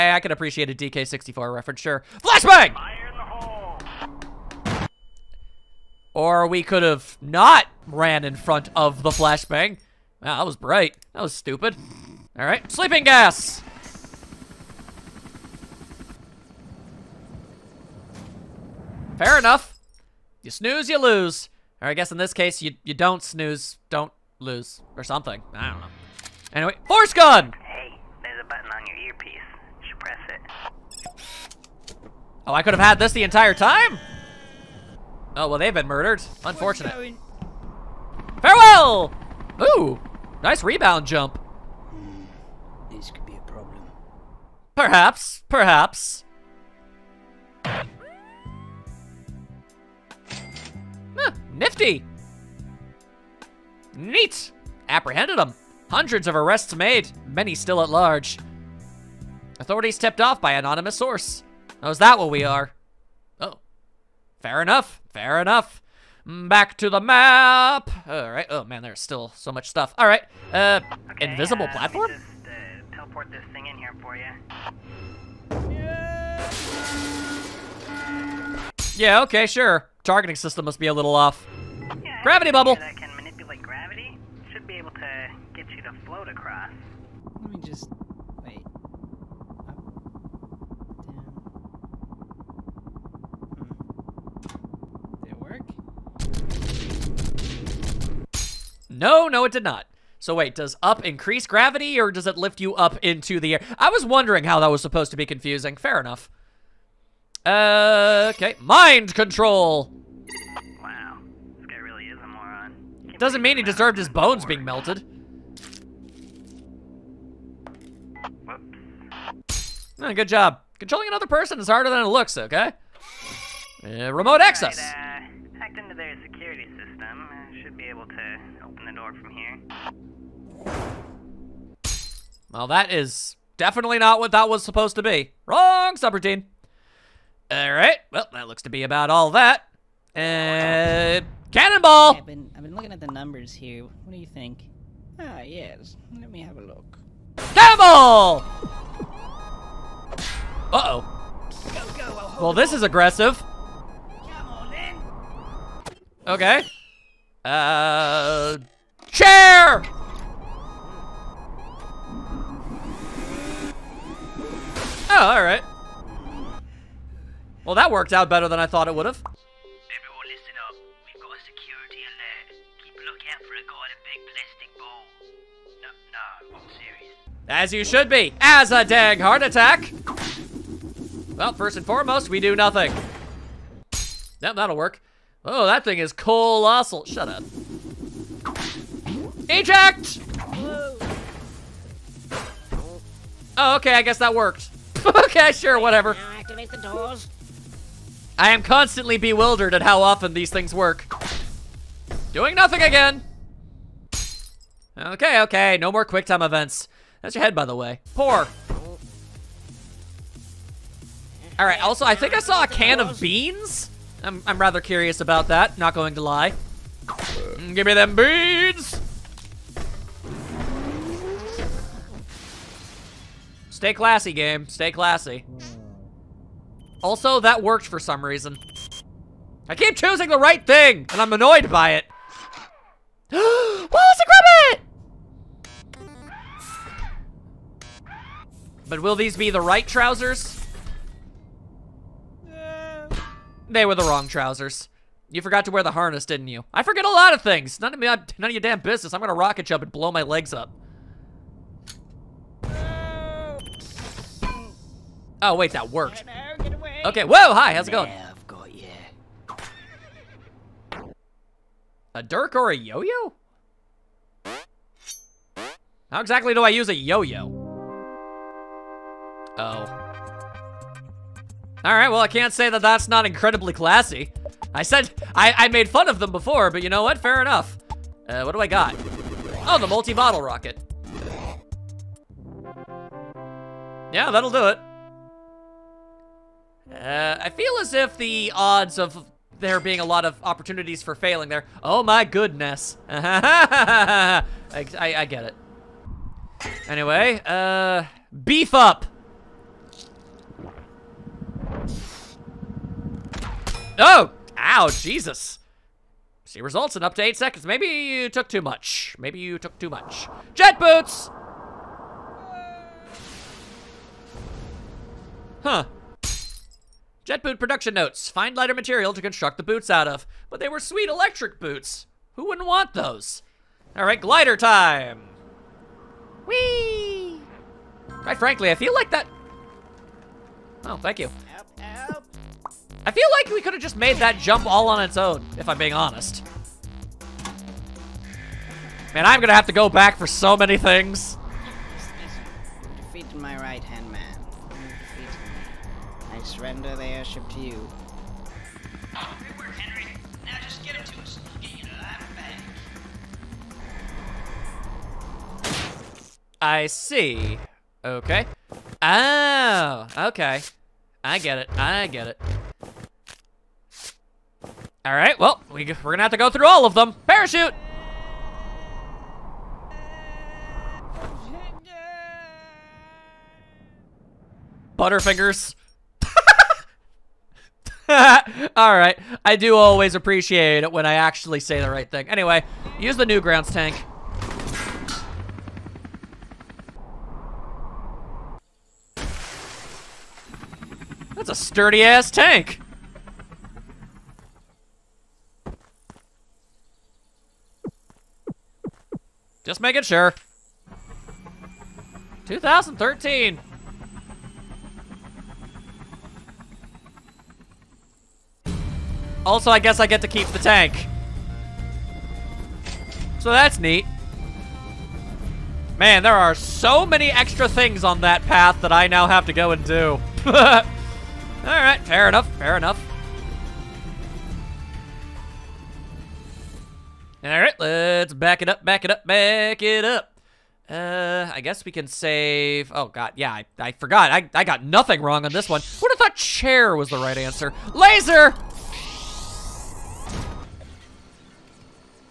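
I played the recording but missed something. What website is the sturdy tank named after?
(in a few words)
Newgrounds.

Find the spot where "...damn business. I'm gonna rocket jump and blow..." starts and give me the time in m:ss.
4:08.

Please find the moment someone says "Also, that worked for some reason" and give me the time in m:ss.
3:47.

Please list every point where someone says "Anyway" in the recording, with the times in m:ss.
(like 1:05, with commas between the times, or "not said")
0:26, 4:56, 6:22.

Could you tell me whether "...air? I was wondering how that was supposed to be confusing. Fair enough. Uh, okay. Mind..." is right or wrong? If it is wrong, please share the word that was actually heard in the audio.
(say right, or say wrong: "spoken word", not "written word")
right.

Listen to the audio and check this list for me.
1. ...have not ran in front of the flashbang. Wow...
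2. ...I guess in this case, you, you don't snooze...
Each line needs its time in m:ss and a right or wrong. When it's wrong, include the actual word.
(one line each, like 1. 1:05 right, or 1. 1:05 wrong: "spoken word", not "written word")
1. 0:06 right
2. 0:21 right.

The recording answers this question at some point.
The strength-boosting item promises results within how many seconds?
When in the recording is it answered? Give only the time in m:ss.
5:07.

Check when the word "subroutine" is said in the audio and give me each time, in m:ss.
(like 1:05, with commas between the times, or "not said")
2:15.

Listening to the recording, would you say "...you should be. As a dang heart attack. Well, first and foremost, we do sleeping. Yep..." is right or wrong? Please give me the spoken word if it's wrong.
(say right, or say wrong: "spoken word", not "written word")
wrong: "nothing", not "sleeping".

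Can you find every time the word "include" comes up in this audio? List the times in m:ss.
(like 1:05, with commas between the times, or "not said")
not said.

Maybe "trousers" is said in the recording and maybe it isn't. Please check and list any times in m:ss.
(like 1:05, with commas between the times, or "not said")
3:59, 4:04.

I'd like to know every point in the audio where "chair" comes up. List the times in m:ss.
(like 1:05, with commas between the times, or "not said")
2:39, 7:16.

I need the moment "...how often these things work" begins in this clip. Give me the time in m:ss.
3:19.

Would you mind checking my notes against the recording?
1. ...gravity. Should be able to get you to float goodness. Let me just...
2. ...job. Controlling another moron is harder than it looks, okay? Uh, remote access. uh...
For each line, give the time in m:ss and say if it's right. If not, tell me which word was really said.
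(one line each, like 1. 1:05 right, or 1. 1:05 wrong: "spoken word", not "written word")
1. 1:23 wrong: "across", not "goodness"
2. 2:00 wrong: "person", not "moron".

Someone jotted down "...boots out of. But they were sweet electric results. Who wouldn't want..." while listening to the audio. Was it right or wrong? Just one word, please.
wrong.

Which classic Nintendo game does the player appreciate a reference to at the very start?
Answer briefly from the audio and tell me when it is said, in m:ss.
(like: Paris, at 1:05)
DK64, at 0:00.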